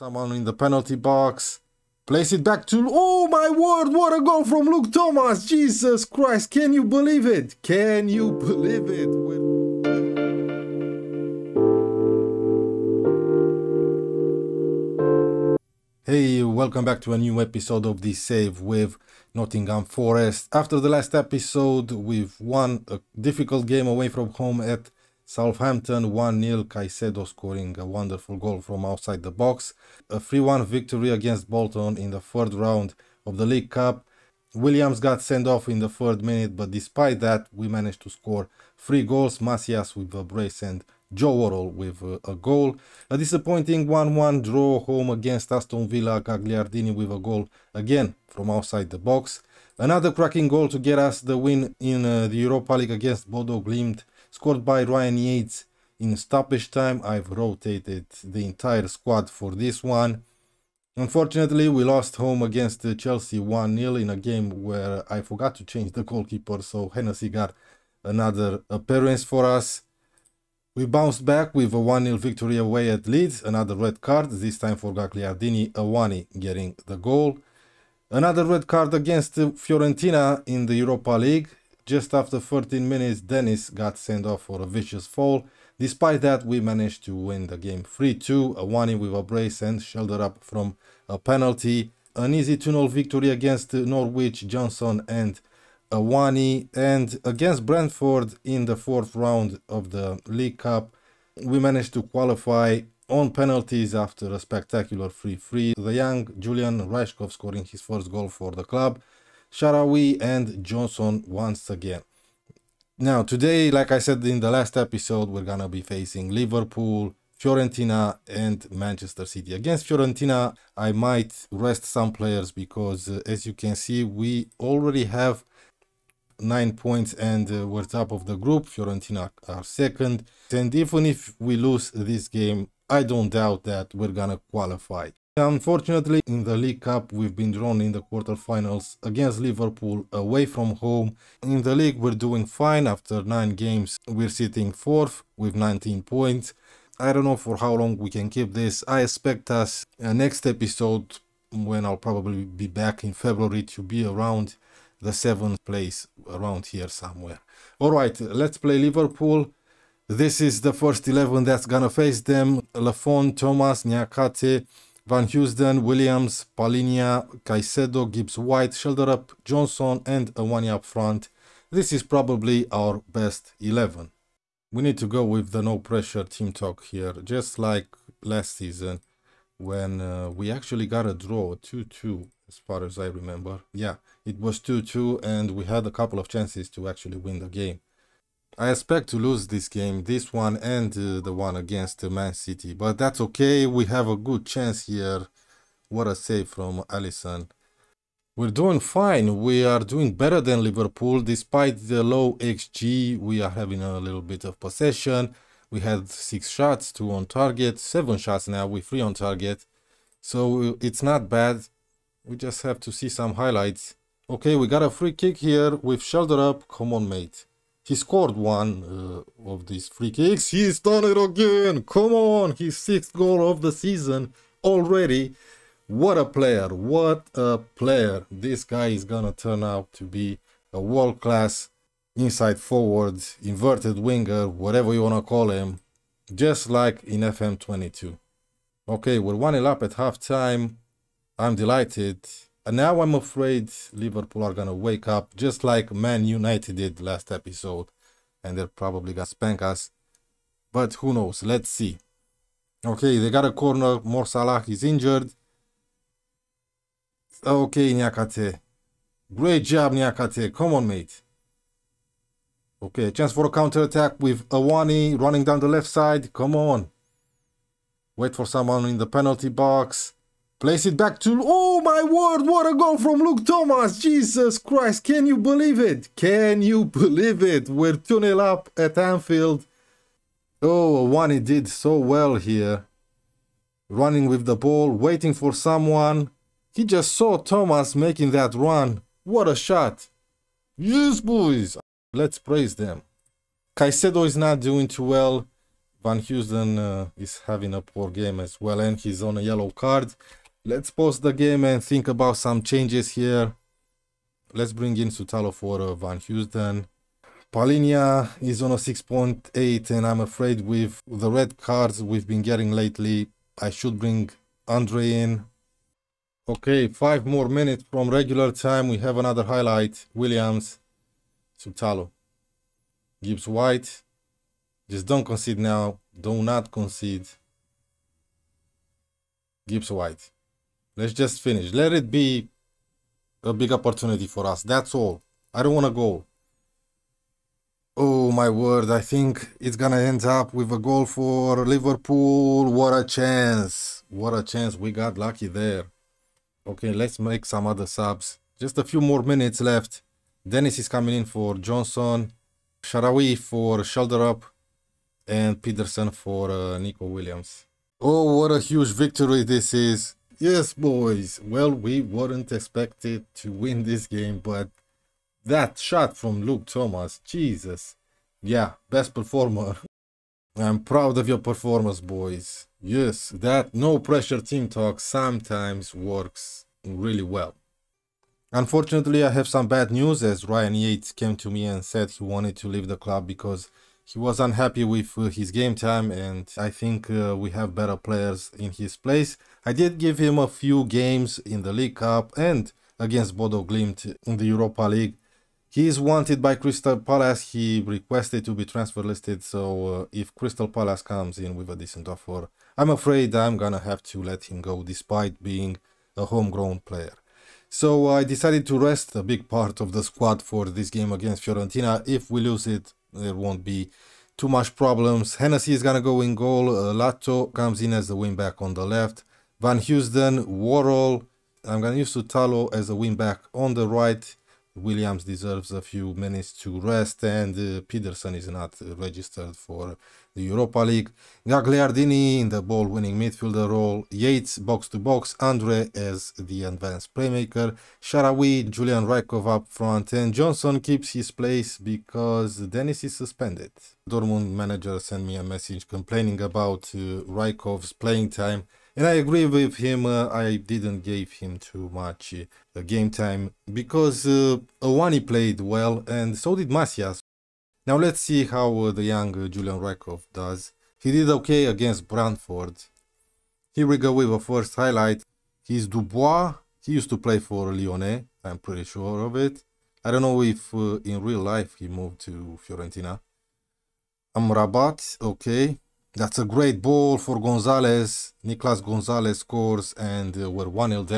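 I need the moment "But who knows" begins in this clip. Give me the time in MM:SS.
04:10.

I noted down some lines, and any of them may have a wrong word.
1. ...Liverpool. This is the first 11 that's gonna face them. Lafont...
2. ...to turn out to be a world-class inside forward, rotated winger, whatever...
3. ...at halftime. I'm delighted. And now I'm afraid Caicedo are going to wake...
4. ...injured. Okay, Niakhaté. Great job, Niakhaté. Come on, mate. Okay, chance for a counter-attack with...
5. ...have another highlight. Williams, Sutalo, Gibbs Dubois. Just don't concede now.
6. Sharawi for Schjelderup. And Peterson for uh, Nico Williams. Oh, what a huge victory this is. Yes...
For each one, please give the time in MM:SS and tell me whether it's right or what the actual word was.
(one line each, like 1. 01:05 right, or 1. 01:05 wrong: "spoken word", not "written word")
1. 02:38 right
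2. 03:49 wrong: "inverted", not "rotated"
3. 03:59 wrong: "Liverpool", not "Caicedo"
4. 04:14 right
5. 05:18 wrong: "White", not "Dubois"
6. 05:52 right.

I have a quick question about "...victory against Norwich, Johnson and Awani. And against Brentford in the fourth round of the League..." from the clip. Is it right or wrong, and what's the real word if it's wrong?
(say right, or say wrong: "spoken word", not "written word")
right.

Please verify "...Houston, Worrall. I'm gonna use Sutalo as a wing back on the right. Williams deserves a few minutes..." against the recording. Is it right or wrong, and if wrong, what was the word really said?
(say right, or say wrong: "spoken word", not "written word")
right.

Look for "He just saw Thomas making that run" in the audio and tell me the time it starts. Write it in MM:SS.
04:46.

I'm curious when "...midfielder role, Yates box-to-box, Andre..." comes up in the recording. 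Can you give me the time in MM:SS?
07:13.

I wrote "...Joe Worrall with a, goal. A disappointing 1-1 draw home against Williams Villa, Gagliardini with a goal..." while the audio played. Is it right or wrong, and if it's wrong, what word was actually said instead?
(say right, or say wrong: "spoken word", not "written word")
wrong: "Aston", not "Williams".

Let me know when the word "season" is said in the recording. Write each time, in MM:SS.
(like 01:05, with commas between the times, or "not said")
02:58, 03:43.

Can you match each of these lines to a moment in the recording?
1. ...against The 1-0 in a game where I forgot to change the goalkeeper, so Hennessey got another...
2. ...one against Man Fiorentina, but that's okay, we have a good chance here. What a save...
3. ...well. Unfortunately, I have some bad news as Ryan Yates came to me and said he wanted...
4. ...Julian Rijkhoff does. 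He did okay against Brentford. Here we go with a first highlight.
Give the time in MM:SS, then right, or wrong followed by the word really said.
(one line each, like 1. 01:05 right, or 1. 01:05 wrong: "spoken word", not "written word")
1. 01:02 wrong: "Chelsea", not "The"
2. 03:11 wrong: "City", not "Fiorentina"
3. 06:17 right
4. 07:39 right.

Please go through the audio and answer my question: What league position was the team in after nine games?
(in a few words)
4th.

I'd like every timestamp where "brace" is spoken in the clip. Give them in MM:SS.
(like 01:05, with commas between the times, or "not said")
00:40, 01:29.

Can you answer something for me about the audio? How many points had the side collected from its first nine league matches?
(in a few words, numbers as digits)
19.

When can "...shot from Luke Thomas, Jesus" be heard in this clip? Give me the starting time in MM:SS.
06:05.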